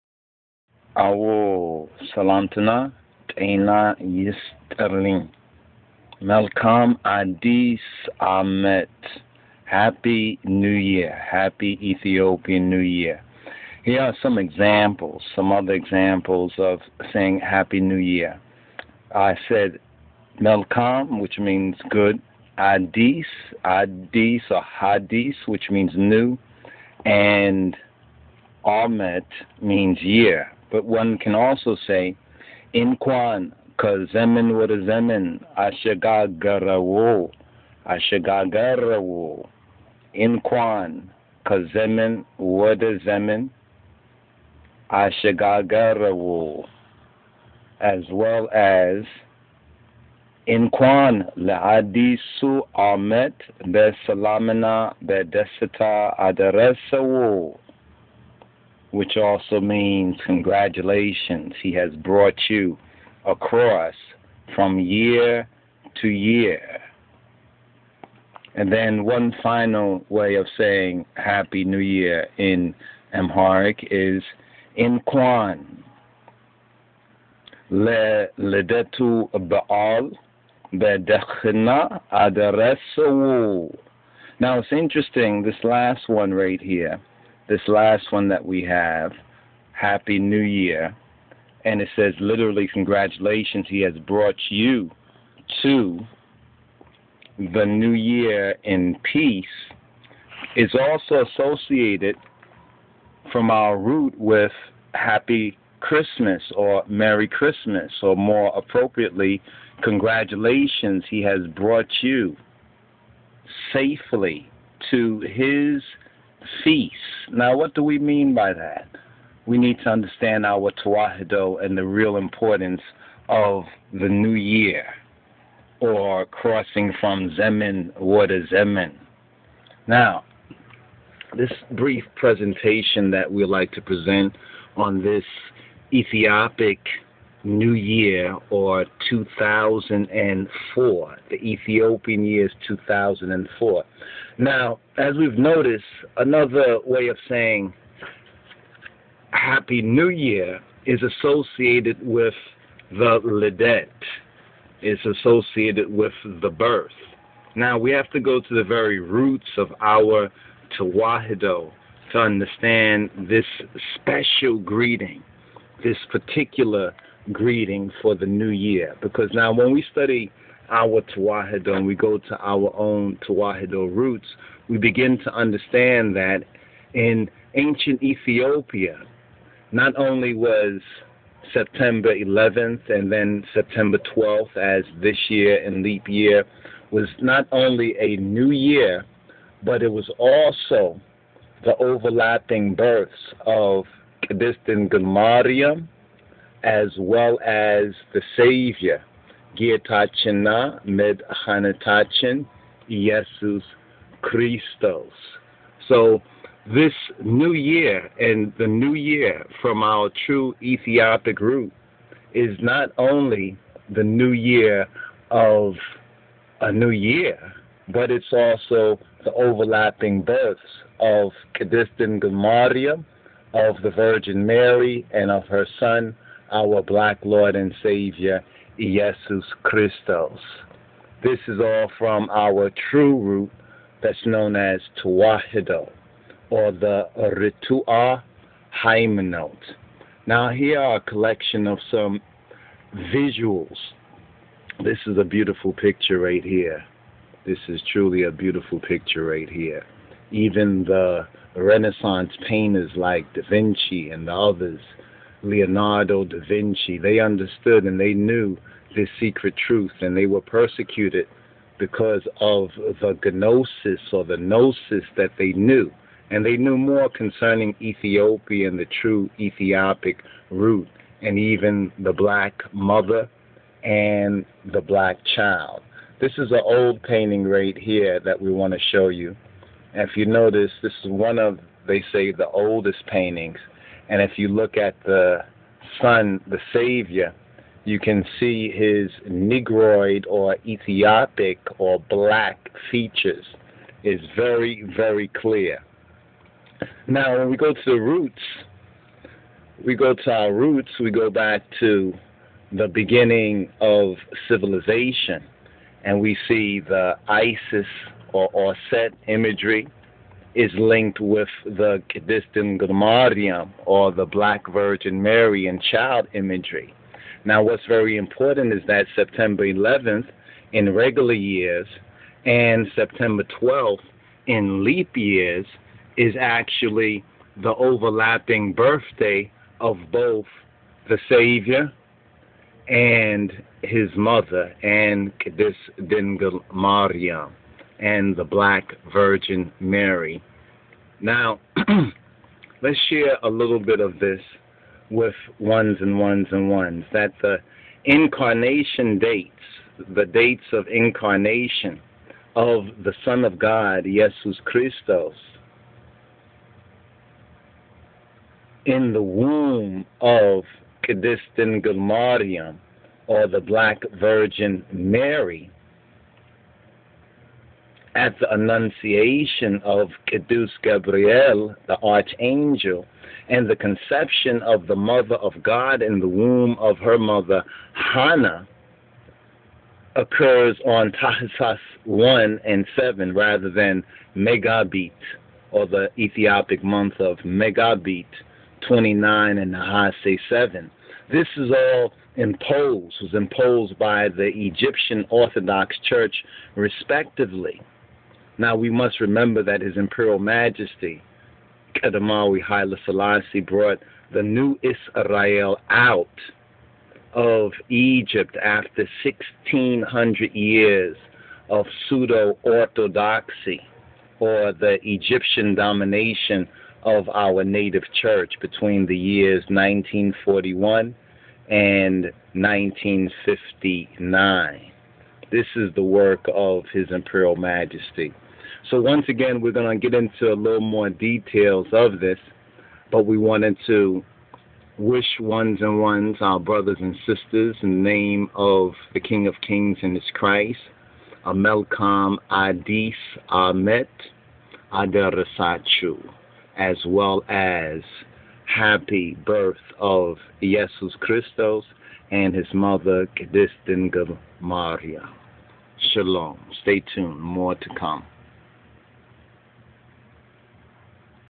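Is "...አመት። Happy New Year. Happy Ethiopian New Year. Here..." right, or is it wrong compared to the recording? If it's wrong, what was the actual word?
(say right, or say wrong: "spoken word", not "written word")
right.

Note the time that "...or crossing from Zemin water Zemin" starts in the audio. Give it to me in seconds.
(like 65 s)
125 s.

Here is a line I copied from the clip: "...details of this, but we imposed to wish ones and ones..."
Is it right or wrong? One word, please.
wrong.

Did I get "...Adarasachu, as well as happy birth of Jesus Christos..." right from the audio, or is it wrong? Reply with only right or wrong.
right.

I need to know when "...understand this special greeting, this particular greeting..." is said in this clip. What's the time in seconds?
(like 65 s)
162 s.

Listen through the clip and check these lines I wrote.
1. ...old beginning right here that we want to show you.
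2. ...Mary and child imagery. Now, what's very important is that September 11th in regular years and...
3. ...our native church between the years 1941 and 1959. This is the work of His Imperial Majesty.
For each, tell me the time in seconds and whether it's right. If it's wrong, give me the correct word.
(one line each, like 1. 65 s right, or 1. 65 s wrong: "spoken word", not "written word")
1. 276 s wrong: "painting", not "beginning"
2. 315 s right
3. 417 s right.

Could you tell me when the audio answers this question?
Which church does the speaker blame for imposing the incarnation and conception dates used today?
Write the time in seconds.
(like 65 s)
394 s.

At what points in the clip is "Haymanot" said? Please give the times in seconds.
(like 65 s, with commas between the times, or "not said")
238 s.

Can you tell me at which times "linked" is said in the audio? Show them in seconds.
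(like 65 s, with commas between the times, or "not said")
310 s.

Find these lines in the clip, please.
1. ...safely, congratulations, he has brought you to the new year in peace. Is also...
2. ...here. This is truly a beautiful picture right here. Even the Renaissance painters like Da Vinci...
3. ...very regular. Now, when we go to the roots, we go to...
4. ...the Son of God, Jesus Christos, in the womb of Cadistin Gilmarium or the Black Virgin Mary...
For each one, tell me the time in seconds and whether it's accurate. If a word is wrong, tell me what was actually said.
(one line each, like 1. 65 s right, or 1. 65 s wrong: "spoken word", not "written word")
1. 92 s wrong: "literally", not "safely"
2. 246 s right
3. 294 s wrong: "clear", not "regular"
4. 353 s right.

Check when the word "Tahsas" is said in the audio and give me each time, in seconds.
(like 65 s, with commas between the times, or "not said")
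381 s.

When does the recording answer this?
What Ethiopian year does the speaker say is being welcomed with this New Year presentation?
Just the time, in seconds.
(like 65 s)
141 s.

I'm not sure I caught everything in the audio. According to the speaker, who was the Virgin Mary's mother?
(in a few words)
Hannah.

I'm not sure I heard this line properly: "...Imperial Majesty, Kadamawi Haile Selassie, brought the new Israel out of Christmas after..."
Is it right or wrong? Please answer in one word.
wrong.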